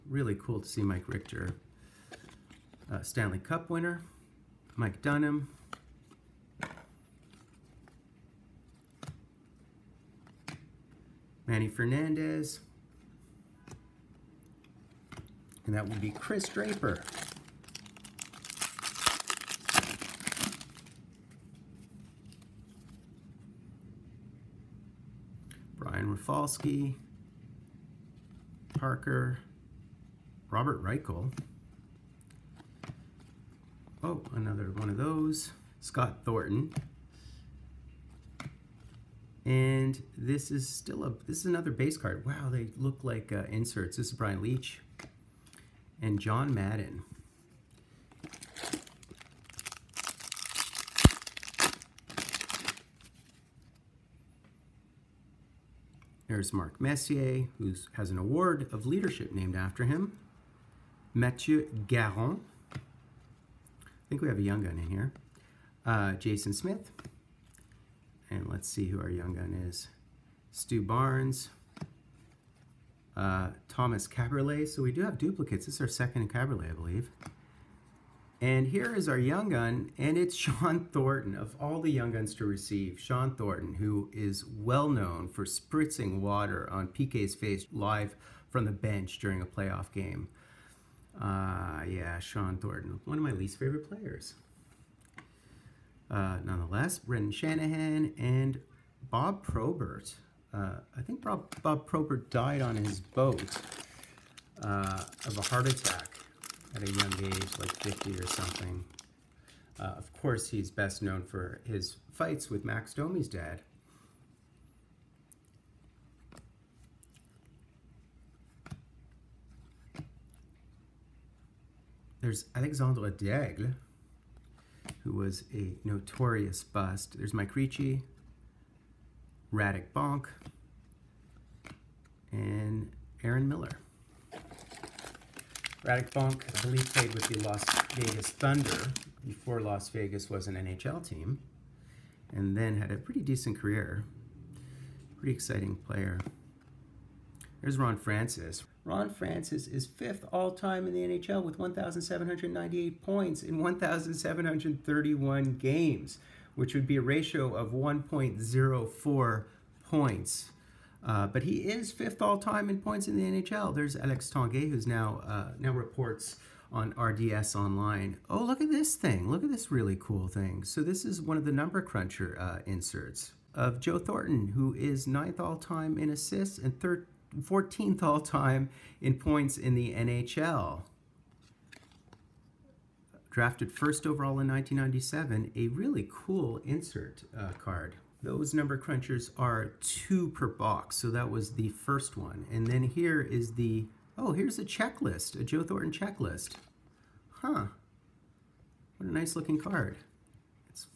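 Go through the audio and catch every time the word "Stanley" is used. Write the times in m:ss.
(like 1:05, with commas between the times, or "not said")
0:03.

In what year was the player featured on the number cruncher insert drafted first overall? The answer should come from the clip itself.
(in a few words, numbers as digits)
1997.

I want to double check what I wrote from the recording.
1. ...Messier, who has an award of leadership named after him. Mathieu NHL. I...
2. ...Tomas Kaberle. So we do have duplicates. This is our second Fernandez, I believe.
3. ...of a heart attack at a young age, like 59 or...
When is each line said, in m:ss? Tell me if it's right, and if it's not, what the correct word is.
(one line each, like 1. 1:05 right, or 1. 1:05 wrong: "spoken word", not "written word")
1. 0:56 wrong: "Garon", not "NHL"
2. 1:13 wrong: "Caberlet", not "Fernandez"
3. 1:45 wrong: "50", not "59".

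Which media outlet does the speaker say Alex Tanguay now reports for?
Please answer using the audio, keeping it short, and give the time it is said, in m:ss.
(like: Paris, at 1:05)
RDS Online, at 2:46.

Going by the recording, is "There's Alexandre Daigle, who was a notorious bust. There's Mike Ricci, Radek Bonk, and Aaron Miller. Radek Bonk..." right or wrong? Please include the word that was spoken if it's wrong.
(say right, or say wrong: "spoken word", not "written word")
right.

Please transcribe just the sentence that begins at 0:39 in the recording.
And this is still a, this is another base card.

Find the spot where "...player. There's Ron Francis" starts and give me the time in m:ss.
2:25.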